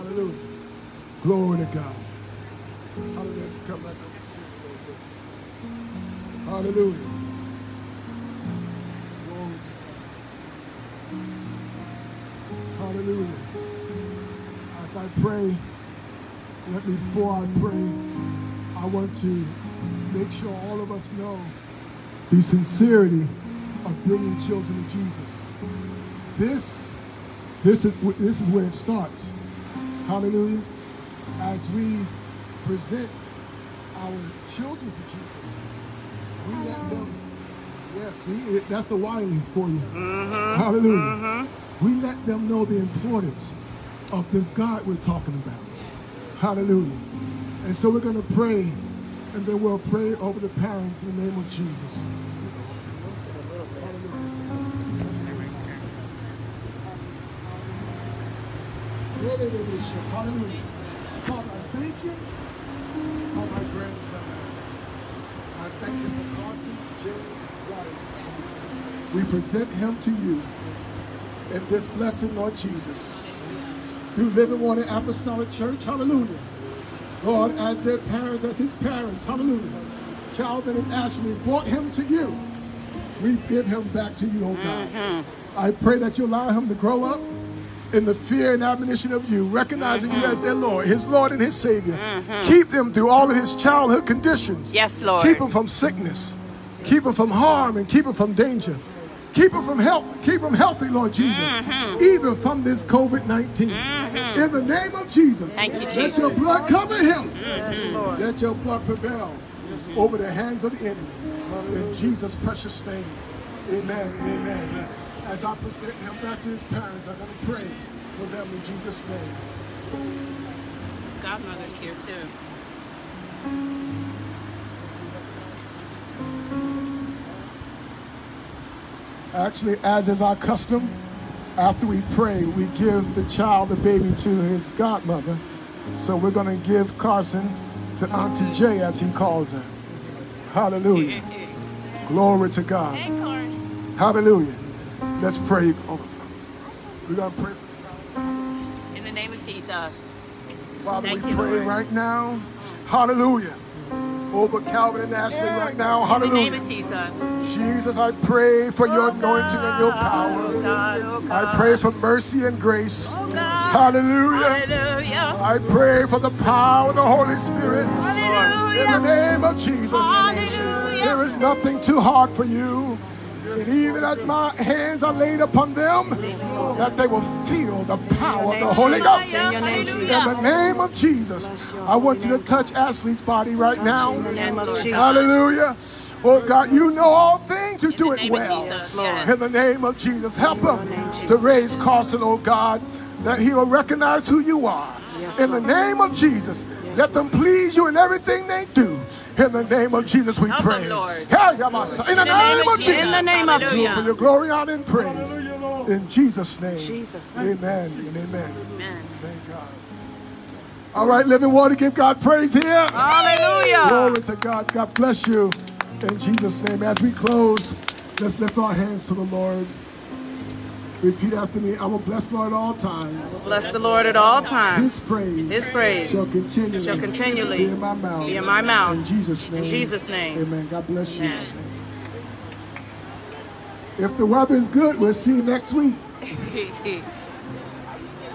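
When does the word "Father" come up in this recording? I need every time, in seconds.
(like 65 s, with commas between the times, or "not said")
61 s, 150 s.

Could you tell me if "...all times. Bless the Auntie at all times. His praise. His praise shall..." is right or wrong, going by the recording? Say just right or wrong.
wrong.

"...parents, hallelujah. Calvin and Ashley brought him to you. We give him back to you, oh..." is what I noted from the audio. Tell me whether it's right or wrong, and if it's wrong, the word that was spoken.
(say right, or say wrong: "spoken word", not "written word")
right.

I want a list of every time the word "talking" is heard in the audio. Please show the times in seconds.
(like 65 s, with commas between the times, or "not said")
44 s.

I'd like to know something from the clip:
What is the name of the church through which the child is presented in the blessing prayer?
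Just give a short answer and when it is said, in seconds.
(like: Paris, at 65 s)
Living Water Apostolic Church, at 74 s.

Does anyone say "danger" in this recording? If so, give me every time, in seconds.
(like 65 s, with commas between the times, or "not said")
98 s.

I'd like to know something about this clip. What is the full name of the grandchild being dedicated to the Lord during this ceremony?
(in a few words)
Carson James Wiley.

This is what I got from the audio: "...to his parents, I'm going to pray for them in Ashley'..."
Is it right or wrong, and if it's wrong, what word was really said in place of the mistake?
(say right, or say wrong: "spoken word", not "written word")
wrong: "Jesus", not "Ashley".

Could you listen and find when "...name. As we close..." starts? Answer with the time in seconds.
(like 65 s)
216 s.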